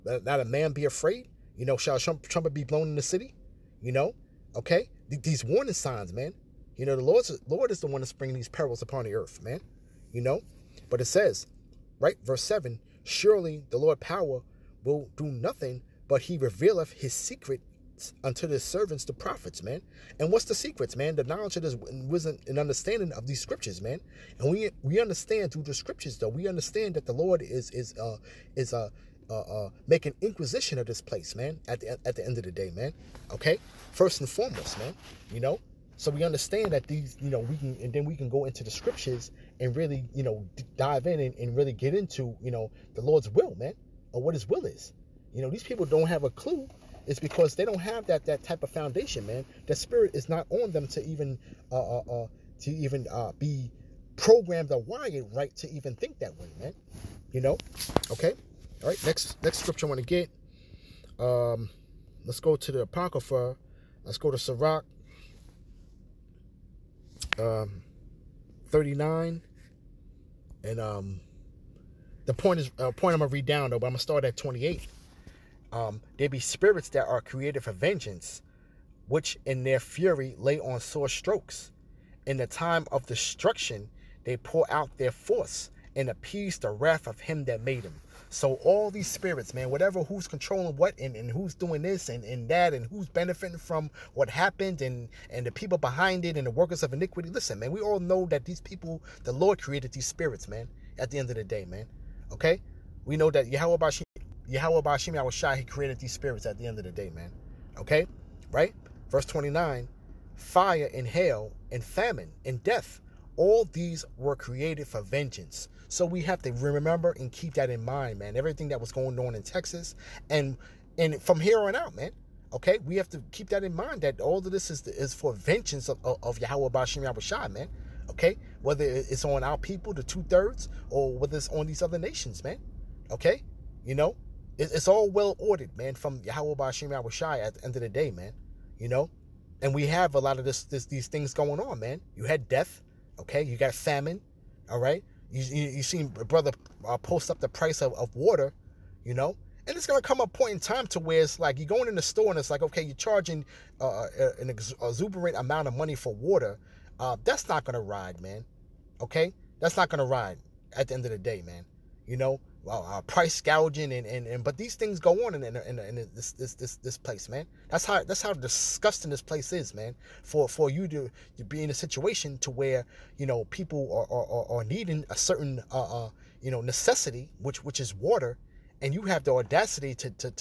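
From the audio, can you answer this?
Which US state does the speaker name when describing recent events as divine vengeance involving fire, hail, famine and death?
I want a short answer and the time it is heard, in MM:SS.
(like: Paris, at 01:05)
Texas, at 01:59.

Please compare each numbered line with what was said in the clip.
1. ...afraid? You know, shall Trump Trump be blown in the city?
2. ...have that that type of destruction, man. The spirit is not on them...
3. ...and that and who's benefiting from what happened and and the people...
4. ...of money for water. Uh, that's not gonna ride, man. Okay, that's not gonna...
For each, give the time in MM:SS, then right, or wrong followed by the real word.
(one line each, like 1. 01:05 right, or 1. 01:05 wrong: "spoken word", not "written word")
1. 00:00 right
2. 00:47 wrong: "foundation", not "destruction"
3. 01:32 right
4. 02:35 right.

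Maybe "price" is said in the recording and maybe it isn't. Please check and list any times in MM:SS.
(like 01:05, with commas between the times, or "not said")
02:27, 02:43.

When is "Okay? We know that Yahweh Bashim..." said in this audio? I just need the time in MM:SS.
01:42.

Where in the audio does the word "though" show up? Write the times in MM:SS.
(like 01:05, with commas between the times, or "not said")
00:26, 01:13.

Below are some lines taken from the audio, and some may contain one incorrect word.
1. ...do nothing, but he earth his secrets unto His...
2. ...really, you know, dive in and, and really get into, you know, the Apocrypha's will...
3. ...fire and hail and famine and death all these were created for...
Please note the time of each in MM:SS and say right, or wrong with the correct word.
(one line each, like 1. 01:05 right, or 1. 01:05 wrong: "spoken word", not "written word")
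1. 00:15 wrong: "revealeth", not "earth"
2. 00:39 wrong: "Lord", not "Apocrypha"
3. 01:50 right.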